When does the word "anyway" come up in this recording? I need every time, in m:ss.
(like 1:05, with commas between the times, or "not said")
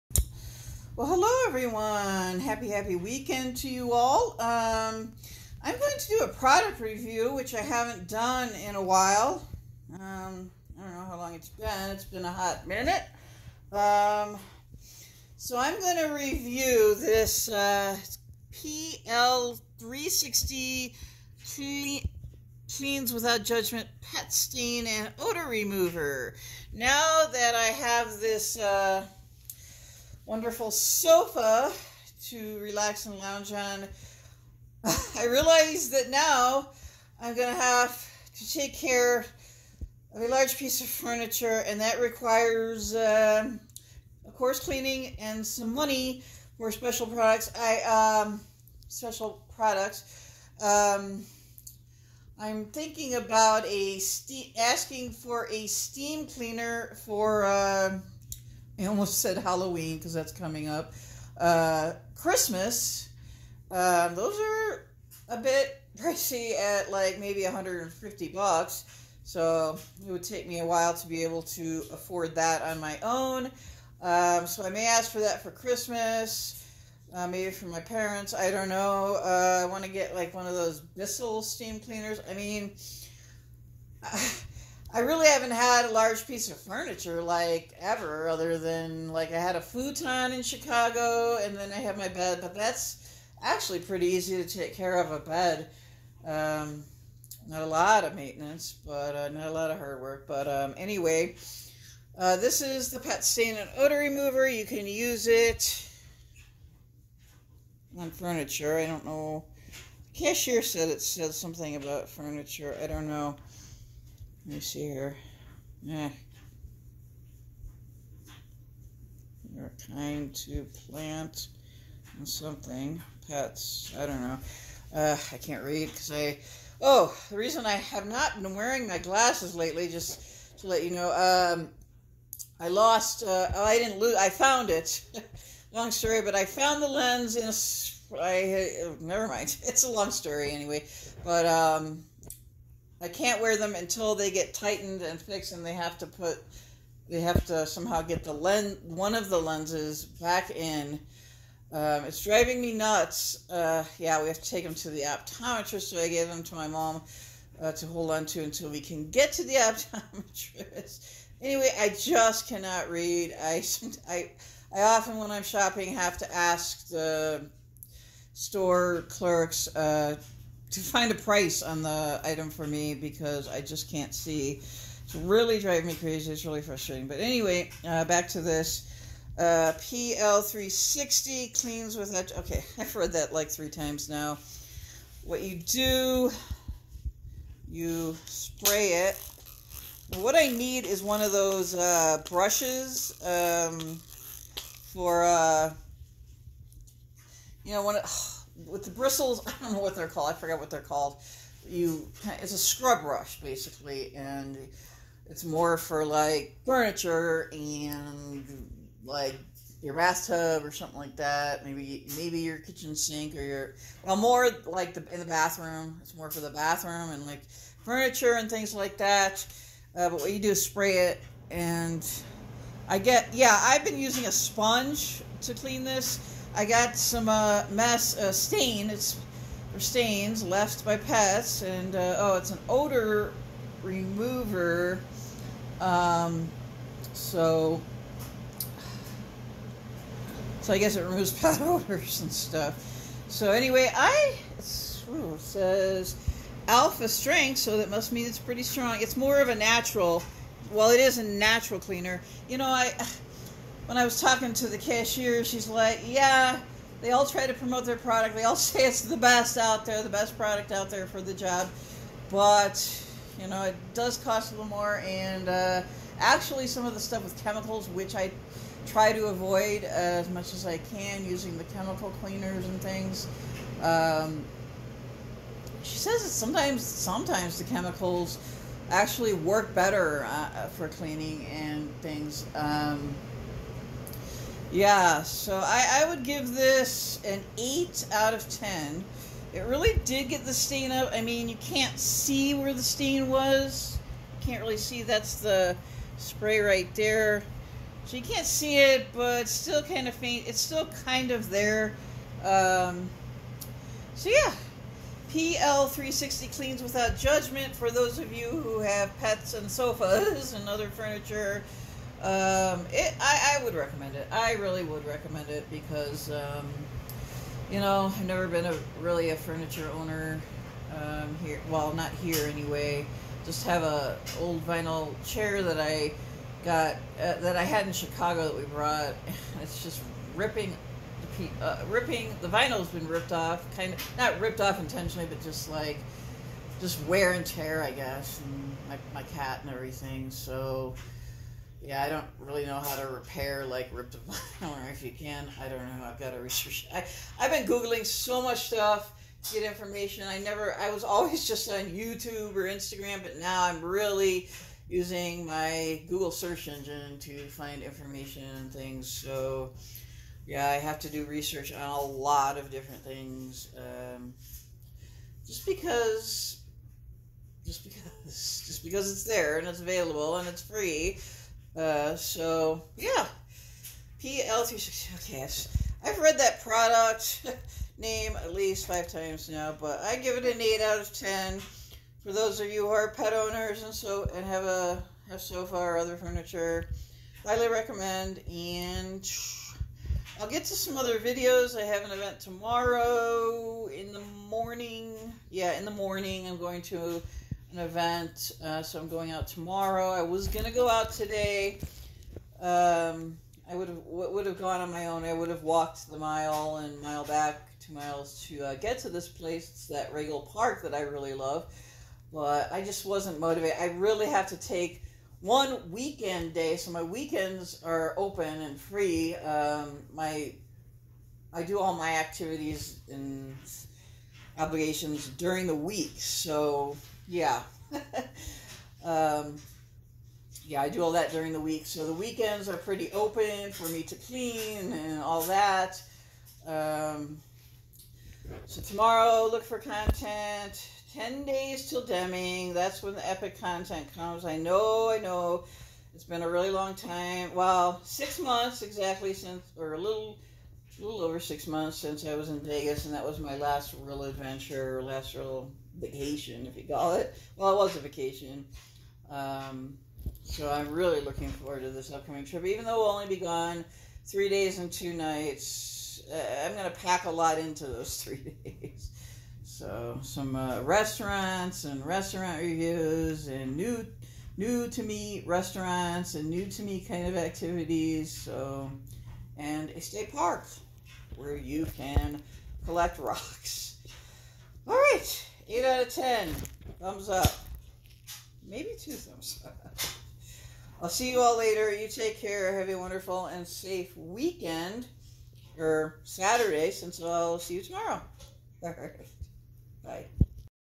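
1:40, 2:20, 2:41, 2:57, 4:03, 5:22.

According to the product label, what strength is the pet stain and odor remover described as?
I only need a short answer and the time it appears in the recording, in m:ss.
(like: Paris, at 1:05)
Alpha strength, at 4:06.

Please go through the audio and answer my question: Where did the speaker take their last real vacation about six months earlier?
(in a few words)
Vegas.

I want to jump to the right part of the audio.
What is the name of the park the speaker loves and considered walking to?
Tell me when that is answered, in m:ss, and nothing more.
6:50.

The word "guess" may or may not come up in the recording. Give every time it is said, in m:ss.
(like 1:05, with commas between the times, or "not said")
4:00, 5:37.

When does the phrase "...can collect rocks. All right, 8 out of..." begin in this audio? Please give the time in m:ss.
8:01.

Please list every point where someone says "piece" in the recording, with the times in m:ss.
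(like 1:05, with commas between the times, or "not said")
0:40, 1:26.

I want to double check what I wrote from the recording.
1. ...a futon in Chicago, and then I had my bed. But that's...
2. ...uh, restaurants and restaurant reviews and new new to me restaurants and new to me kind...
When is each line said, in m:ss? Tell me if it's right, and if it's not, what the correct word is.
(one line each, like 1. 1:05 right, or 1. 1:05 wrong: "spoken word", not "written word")
1. 1:29 right
2. 7:50 right.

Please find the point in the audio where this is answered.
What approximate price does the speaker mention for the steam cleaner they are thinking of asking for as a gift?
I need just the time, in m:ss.
1:07.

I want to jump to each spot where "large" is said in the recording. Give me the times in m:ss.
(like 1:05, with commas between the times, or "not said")
0:40, 1:25.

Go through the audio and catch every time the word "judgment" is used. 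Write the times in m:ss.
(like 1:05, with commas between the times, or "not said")
0:23, 5:07.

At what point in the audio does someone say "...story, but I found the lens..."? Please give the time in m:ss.
2:15.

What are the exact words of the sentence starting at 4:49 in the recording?
It really did get the stain up.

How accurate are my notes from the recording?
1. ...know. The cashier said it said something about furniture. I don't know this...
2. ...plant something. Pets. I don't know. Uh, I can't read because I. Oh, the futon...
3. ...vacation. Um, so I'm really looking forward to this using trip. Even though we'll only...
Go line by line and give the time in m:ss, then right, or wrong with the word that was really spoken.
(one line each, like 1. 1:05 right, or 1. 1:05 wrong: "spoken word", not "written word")
1. 1:49 right
2. 2:00 wrong: "reason", not "futon"
3. 7:38 wrong: "upcoming", not "using".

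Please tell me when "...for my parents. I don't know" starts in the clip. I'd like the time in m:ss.
1:17.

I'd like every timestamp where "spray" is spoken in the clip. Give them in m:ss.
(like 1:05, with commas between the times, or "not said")
3:08, 3:40, 4:56.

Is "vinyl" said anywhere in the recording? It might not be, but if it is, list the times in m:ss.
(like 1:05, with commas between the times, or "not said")
5:24, 5:32.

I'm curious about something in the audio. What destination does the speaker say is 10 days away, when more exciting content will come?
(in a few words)
Deming.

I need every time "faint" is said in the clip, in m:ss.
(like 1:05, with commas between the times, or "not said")
5:00.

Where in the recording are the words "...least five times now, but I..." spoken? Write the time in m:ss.
6:18.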